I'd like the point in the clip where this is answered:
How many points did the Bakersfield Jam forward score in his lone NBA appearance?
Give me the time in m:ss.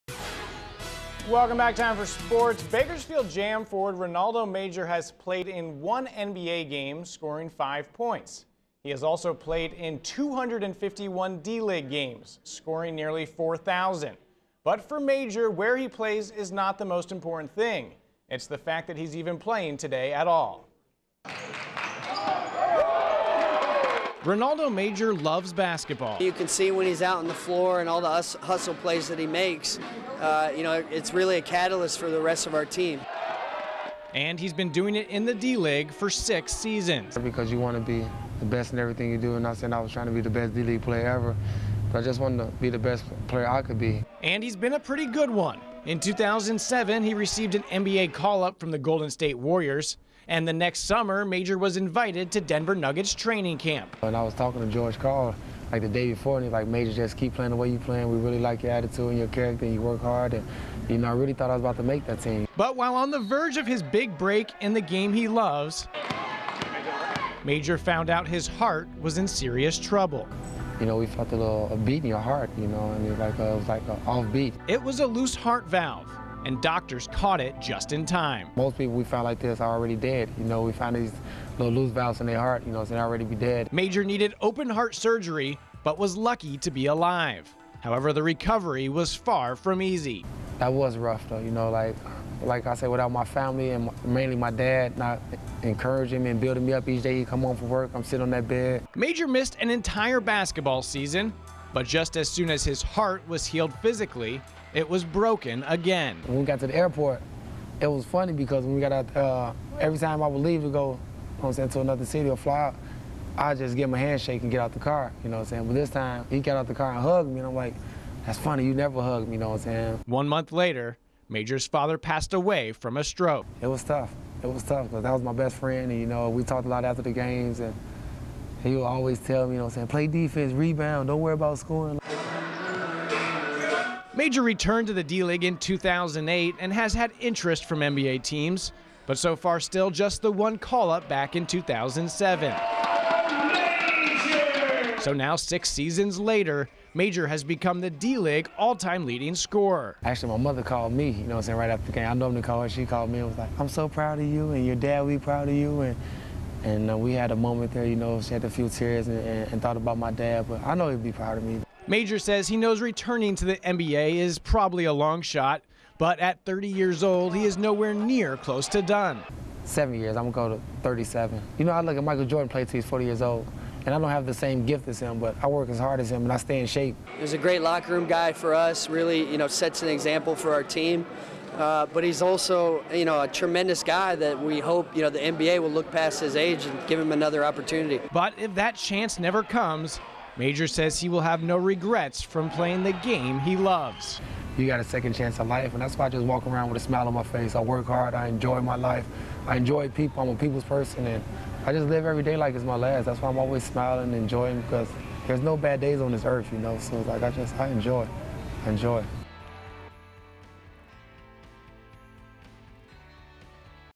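0:07.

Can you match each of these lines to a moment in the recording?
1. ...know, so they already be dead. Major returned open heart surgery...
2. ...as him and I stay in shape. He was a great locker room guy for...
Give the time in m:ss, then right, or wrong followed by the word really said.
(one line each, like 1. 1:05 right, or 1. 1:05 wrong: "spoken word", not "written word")
1. 1:22 wrong: "needed", not "returned"
2. 2:55 right.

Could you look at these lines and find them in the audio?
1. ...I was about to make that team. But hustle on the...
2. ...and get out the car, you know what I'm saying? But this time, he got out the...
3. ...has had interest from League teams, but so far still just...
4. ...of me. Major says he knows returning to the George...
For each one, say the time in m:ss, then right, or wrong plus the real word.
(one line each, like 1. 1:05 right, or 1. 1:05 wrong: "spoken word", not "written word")
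1. 1:01 wrong: "while", not "hustle"
2. 1:54 right
3. 2:16 wrong: "NBA", not "League"
4. 2:41 wrong: "NBA", not "George".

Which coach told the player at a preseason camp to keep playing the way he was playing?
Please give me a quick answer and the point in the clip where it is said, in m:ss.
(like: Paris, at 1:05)
George Karl, at 0:54.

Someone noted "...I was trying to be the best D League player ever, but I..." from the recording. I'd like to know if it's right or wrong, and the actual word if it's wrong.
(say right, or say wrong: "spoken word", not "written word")
right.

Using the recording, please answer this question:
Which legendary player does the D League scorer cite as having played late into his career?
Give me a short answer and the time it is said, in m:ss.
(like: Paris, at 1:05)
Michael Jordan, at 2:52.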